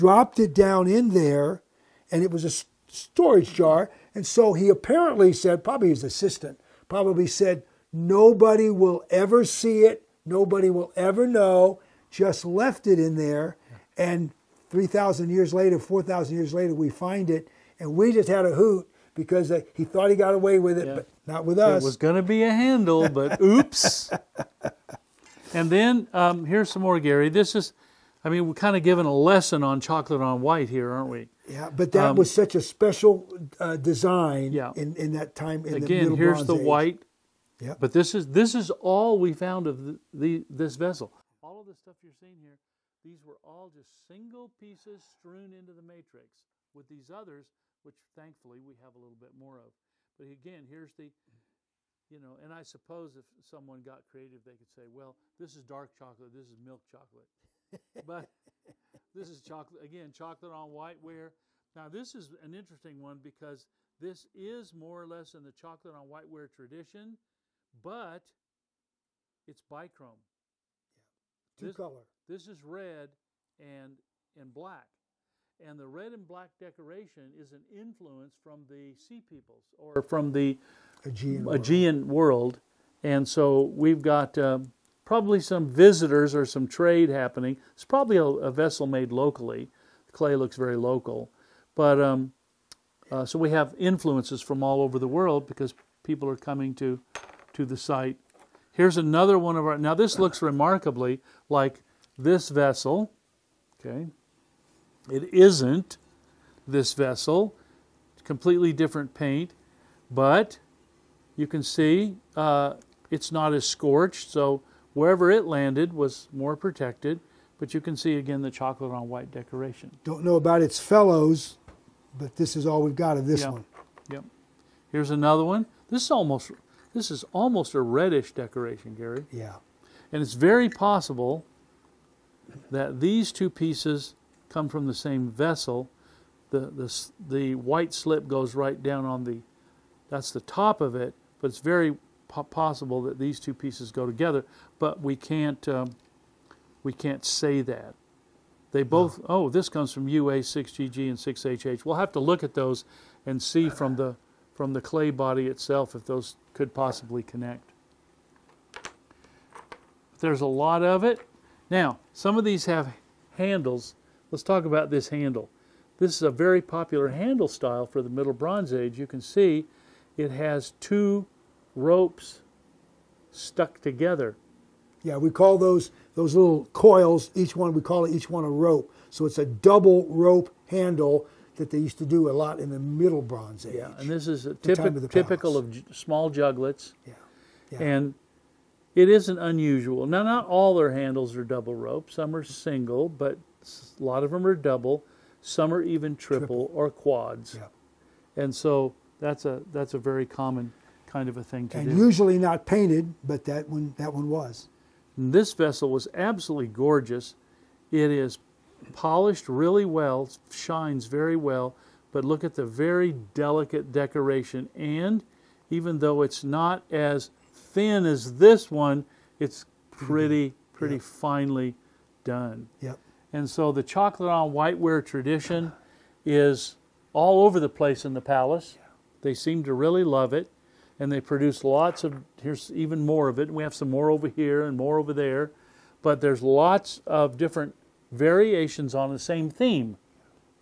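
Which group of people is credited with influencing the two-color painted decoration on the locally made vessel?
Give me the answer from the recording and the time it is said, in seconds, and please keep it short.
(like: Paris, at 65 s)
the sea peoples, at 78 s.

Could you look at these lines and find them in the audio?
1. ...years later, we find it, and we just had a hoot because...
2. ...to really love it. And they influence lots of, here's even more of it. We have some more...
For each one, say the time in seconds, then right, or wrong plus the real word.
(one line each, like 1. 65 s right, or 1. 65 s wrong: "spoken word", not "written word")
1. 16 s right
2. 229 s wrong: "produce", not "influence".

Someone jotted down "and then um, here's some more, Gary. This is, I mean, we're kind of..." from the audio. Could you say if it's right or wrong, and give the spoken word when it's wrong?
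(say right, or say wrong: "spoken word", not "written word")
right.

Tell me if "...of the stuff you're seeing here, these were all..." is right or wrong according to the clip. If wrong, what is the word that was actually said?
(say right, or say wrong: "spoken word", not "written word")
right.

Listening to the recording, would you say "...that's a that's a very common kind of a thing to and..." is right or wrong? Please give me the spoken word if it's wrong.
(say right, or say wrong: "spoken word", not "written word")
right.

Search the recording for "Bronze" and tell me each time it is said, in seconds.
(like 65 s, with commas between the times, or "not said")
168 s, 183 s.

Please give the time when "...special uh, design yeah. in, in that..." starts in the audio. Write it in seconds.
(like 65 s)
32 s.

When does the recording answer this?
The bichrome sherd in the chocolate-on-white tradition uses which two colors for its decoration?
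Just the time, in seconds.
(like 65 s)
75 s.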